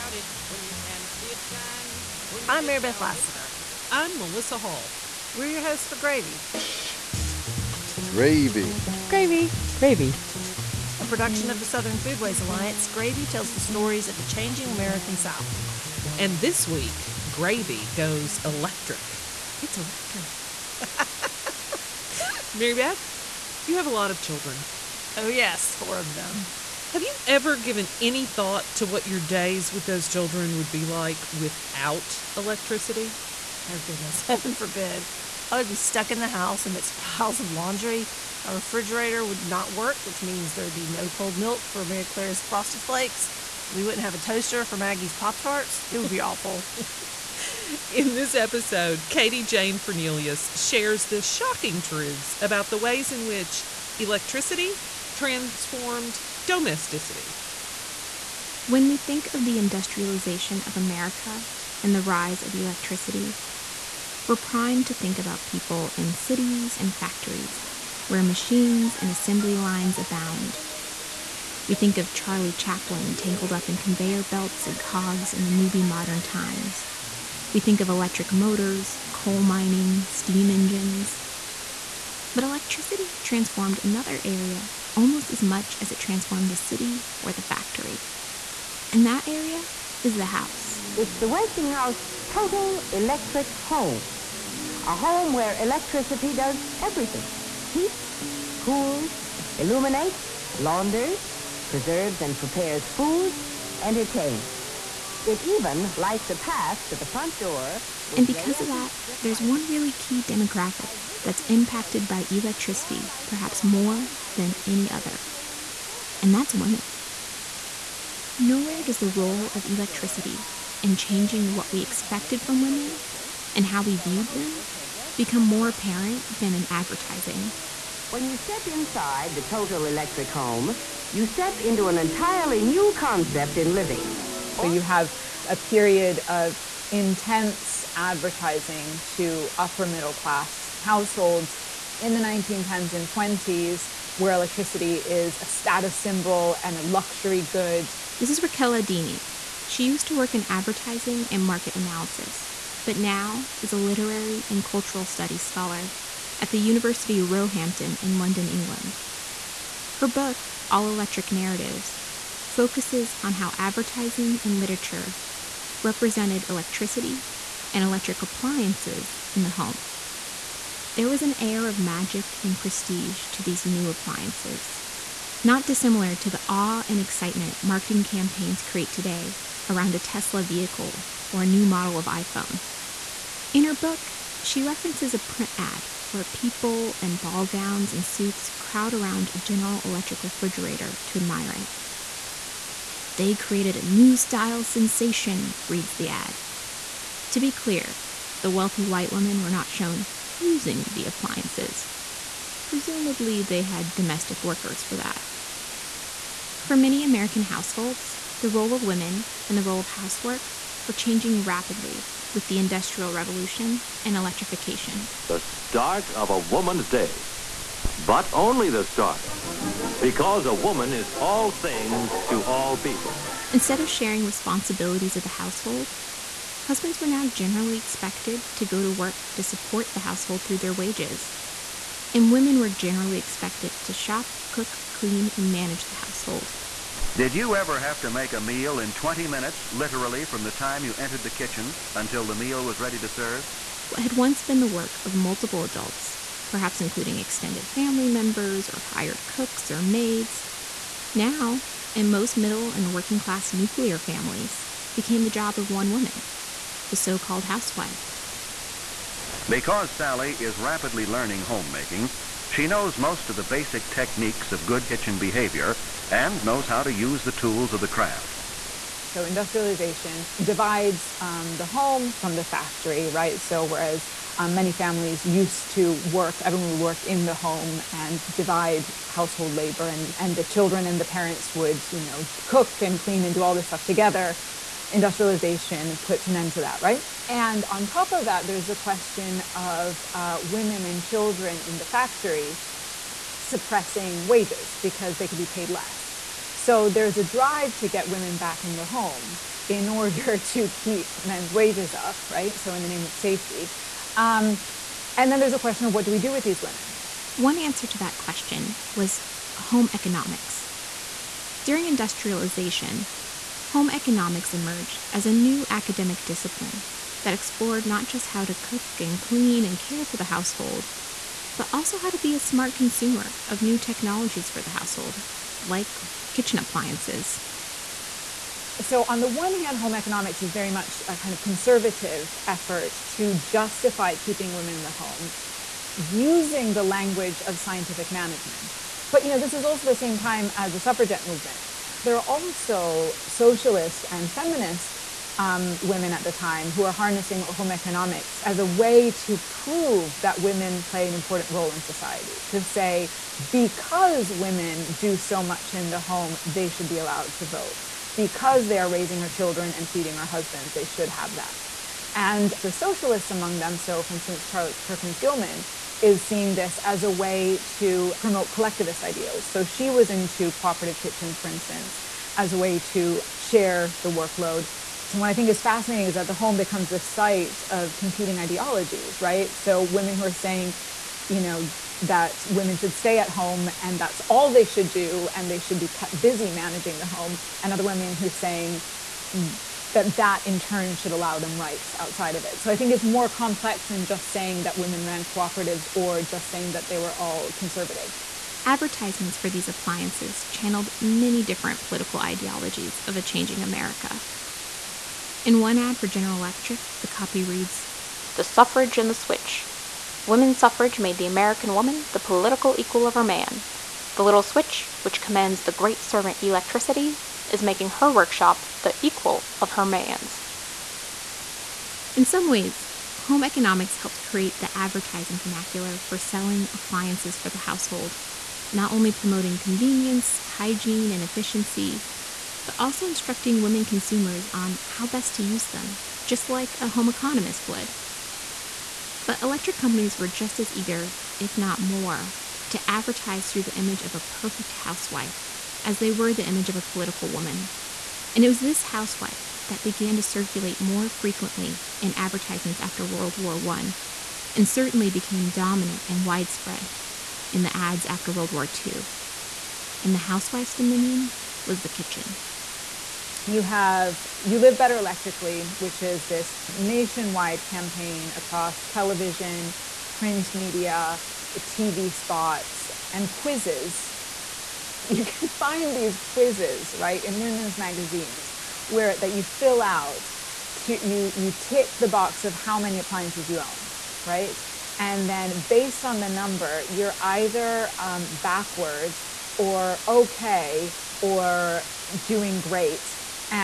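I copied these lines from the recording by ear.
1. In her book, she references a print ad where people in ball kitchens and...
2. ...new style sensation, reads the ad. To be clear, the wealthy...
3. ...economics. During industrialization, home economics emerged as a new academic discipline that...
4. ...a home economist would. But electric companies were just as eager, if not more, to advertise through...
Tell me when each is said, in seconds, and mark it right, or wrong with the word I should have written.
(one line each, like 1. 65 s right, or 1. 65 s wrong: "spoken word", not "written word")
1. 183 s wrong: "gowns", not "kitchens"
2. 193 s right
3. 309 s right
4. 436 s right.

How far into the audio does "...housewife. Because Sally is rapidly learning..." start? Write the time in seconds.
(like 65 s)
257 s.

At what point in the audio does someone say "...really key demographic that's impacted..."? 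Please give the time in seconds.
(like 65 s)
109 s.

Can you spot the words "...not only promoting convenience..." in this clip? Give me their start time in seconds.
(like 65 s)
428 s.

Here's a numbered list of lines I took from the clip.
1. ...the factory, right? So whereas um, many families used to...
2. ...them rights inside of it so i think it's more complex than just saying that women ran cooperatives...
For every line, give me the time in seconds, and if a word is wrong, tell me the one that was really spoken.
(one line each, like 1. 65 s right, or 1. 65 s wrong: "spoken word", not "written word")
1. 272 s right
2. 391 s wrong: "outside", not "inside".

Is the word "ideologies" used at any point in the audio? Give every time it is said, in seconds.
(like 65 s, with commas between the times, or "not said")
378 s, 402 s.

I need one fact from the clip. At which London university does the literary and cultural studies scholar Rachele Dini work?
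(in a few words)
University of Roehampton.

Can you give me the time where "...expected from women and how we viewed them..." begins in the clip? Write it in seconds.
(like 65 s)
121 s.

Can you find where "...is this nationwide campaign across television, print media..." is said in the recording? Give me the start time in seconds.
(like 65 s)
466 s.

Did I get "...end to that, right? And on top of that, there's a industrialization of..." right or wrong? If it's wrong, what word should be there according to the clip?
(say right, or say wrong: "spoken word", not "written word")
wrong: "question", not "industrialization".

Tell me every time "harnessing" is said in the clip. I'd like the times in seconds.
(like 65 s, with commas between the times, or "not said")
346 s.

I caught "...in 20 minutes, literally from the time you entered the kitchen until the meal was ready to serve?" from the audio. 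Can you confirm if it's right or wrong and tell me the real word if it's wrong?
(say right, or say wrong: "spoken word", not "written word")
right.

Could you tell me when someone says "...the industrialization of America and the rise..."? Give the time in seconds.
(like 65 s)
59 s.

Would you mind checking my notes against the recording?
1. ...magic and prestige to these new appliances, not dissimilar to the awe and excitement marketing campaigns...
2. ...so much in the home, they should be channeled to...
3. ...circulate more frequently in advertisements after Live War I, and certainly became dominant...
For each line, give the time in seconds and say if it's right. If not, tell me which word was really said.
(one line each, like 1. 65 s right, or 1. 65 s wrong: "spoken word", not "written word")
1. 171 s right
2. 355 s wrong: "allowed", not "channeled"
3. 450 s wrong: "World", not "Live".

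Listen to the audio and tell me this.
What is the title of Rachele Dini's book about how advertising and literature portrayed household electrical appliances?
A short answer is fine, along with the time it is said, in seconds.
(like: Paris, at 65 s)
All Electric Narratives, at 160 s.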